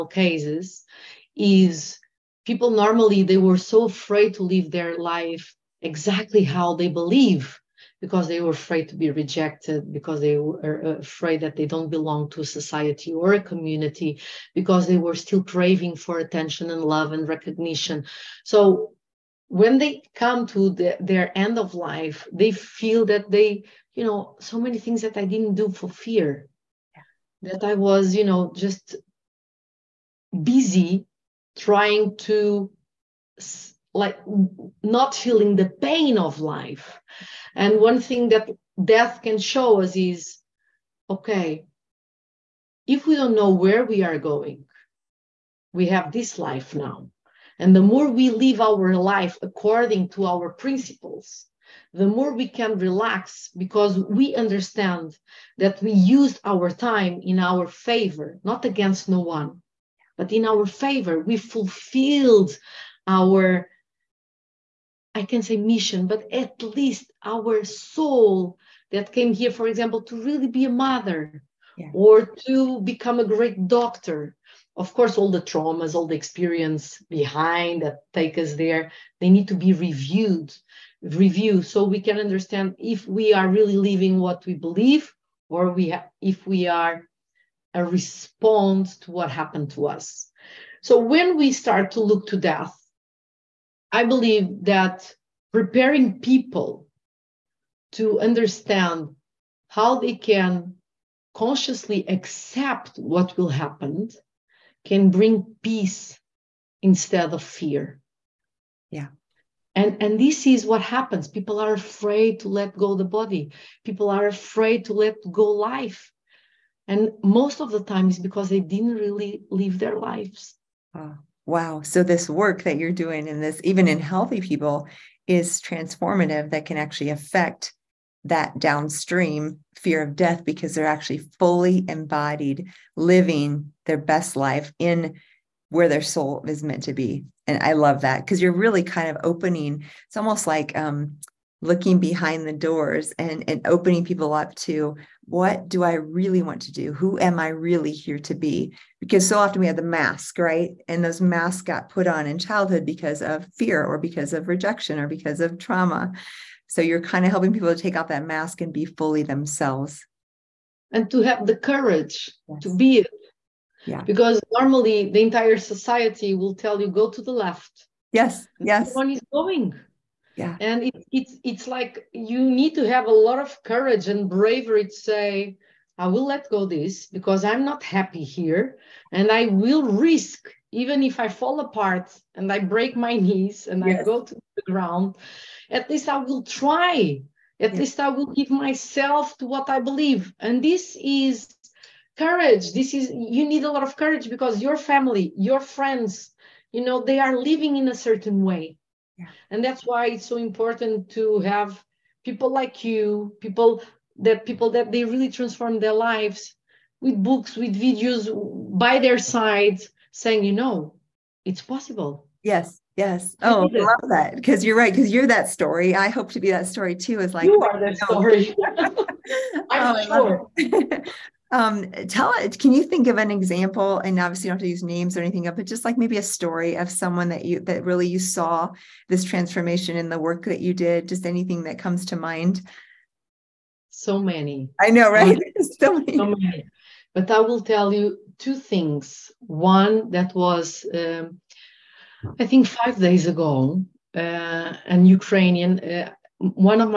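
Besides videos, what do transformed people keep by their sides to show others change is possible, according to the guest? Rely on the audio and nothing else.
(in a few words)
books.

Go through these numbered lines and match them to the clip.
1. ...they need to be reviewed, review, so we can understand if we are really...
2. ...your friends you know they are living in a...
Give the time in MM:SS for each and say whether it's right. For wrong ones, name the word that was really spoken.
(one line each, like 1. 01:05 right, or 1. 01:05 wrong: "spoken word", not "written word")
1. 01:19 right
2. 03:15 right.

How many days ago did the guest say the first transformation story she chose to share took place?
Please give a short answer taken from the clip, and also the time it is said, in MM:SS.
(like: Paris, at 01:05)
5, at 04:02.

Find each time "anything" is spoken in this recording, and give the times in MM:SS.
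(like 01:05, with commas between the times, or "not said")
03:45, 03:51.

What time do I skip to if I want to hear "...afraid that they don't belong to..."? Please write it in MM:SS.
00:10.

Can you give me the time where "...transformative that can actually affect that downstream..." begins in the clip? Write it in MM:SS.
02:05.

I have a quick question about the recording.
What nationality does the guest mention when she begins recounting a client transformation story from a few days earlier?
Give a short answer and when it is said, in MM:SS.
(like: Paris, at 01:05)
Ukrainian, at 04:05.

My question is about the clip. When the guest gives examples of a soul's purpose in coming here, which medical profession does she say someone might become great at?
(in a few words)
doctor.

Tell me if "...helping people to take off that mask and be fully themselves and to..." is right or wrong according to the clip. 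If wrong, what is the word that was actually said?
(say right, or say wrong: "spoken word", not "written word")
right.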